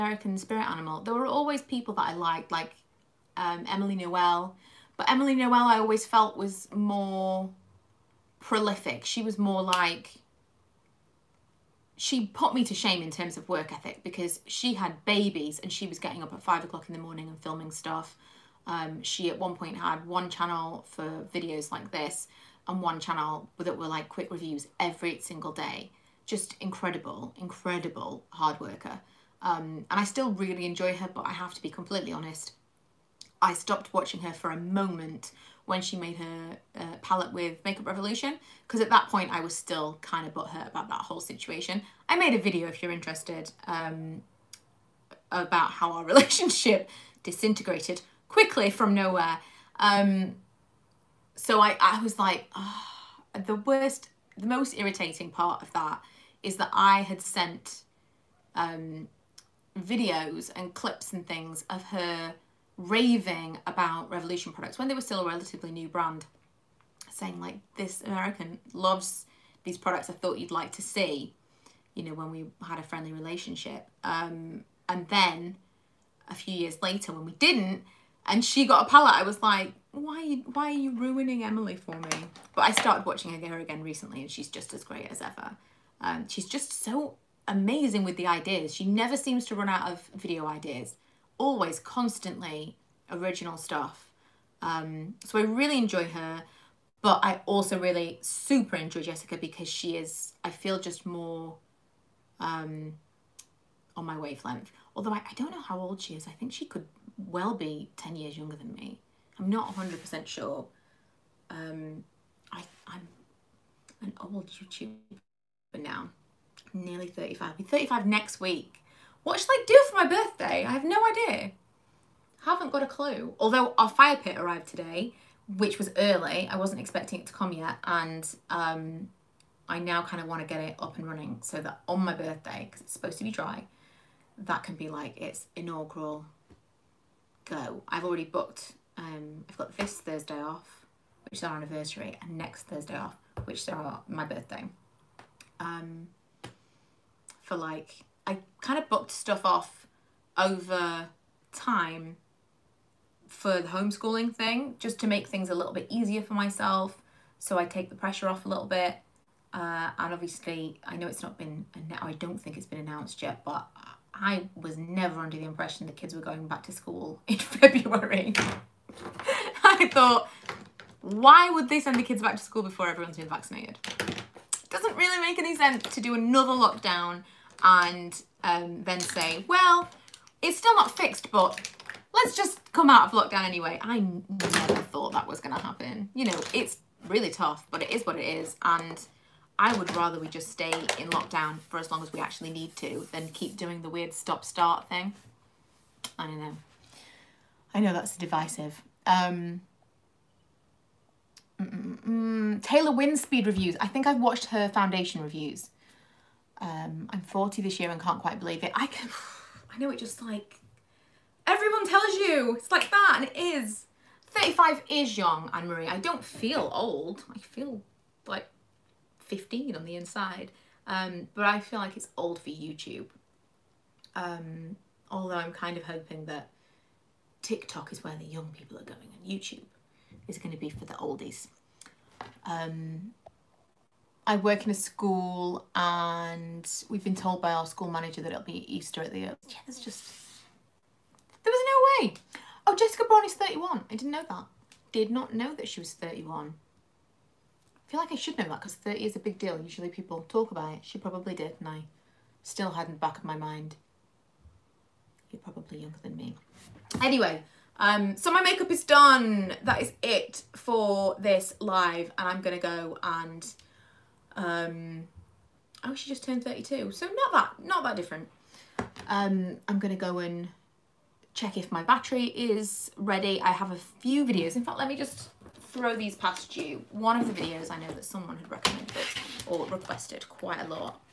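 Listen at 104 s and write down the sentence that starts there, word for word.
Although I, I don't know how old she is.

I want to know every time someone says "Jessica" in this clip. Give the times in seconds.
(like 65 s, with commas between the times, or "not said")
99 s, 242 s.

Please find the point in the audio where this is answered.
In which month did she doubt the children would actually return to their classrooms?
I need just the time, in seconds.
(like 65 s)
167 s.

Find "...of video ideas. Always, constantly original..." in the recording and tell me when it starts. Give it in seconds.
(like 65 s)
89 s.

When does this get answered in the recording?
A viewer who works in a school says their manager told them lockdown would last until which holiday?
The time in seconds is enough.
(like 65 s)
238 s.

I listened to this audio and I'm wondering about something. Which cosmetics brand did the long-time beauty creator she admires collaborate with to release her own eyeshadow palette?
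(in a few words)
Makeup Revolution.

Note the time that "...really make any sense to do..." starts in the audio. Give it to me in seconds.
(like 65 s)
174 s.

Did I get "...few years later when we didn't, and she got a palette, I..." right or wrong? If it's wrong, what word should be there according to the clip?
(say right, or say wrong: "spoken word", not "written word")
right.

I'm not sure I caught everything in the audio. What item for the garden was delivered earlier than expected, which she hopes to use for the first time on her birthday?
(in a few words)
Fire pit.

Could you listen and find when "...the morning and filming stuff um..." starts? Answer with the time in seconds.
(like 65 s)
16 s.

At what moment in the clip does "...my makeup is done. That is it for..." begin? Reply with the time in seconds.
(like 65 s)
258 s.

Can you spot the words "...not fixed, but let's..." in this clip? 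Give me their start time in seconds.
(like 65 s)
180 s.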